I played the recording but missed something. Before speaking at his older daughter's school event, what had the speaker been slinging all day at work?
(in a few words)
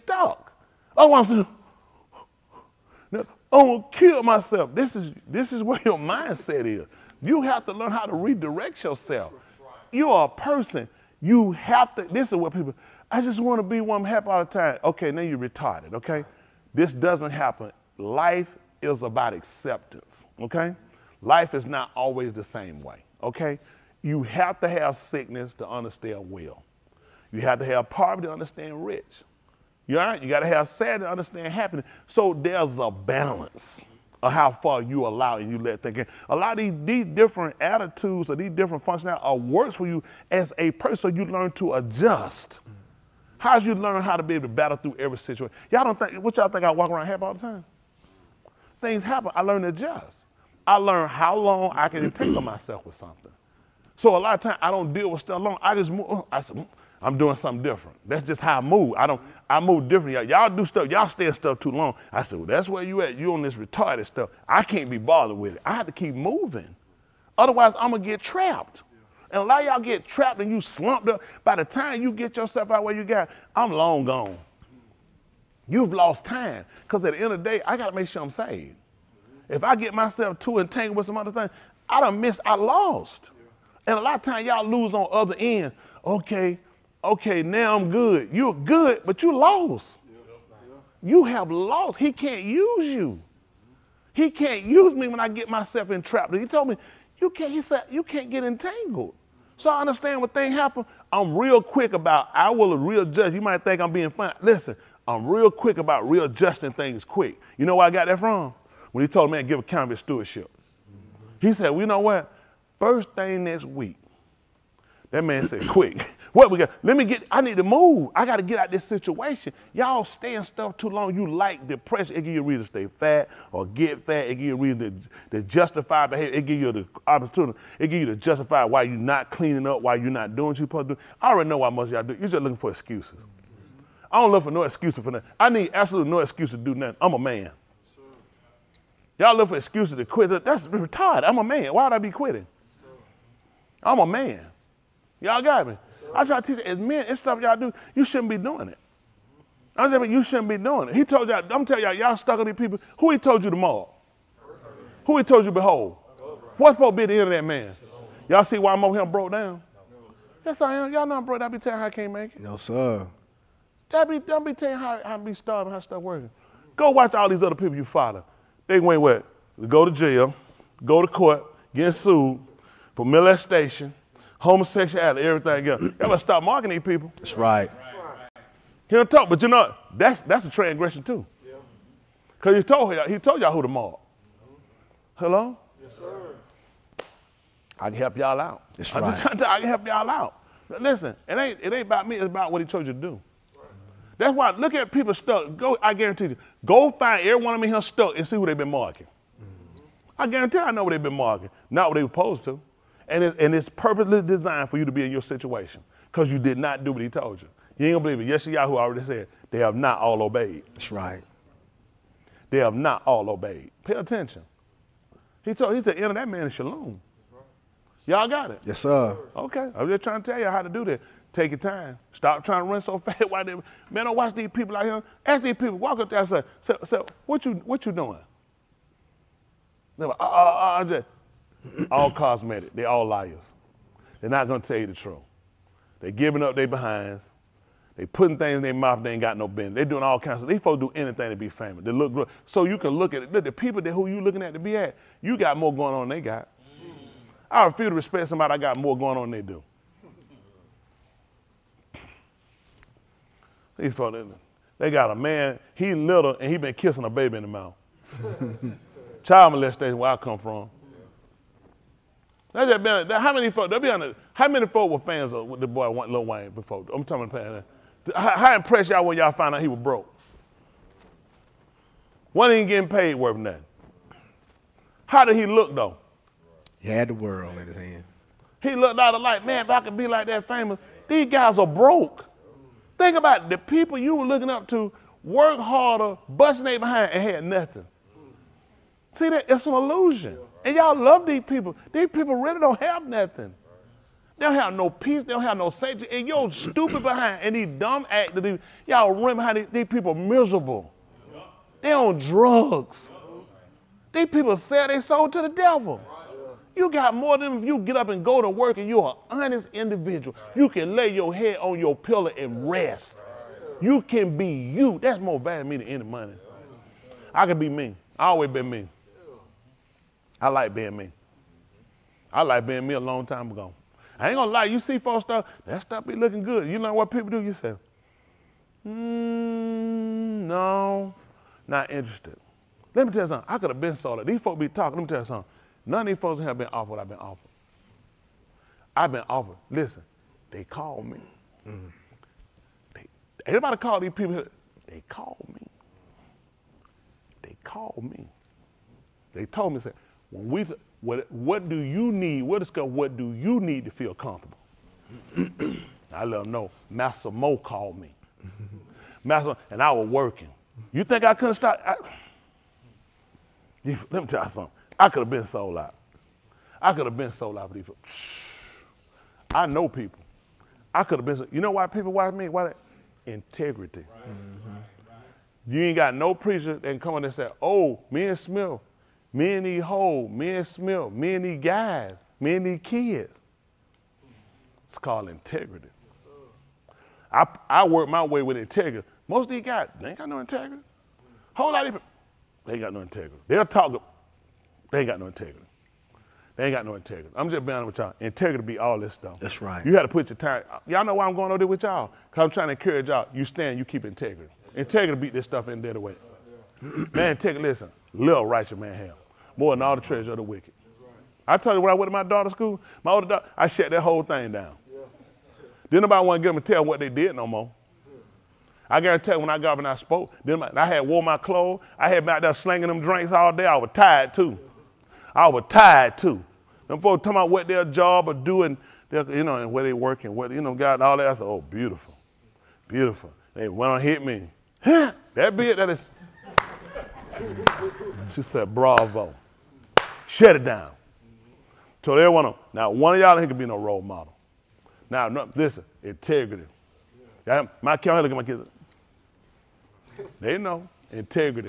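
Drinks.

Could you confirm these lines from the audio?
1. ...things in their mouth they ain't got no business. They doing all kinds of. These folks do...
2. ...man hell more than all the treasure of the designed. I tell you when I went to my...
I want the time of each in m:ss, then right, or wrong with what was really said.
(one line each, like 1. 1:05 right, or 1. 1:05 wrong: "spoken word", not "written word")
1. 3:58 right
2. 6:48 wrong: "wicked", not "designed".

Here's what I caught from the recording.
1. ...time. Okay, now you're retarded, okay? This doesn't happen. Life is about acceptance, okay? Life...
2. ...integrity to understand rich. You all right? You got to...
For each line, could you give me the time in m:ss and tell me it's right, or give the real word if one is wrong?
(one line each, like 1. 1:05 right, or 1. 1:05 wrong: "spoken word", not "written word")
1. 0:14 right
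2. 0:27 wrong: "poverty", not "integrity".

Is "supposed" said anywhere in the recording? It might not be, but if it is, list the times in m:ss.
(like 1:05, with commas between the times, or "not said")
2:10, 2:36, 3:22.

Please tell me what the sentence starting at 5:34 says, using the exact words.
These folks be talking, let me tell you something.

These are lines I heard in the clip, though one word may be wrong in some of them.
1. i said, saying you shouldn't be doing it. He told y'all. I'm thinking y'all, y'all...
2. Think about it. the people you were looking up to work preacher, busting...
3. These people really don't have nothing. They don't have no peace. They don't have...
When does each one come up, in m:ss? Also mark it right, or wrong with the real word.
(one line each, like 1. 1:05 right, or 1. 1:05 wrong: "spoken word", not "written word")
1. 2:29 wrong: "telling", not "thinking"
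2. 4:42 wrong: "harder", not "preacher"
3. 4:51 right.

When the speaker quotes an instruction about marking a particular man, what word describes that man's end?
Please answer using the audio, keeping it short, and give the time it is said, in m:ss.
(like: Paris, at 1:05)
Shalom, at 3:36.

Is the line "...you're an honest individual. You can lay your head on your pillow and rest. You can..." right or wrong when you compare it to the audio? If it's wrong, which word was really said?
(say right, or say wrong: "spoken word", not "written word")
right.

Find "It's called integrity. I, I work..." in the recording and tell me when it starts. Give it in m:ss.
6:24.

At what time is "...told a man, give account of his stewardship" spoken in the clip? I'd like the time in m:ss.
1:49.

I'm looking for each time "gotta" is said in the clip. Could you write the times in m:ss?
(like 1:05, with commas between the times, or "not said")
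1:17, 2:55.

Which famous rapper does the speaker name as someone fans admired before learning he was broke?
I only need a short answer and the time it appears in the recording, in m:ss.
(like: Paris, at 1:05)
Lil Wayne, at 4:26.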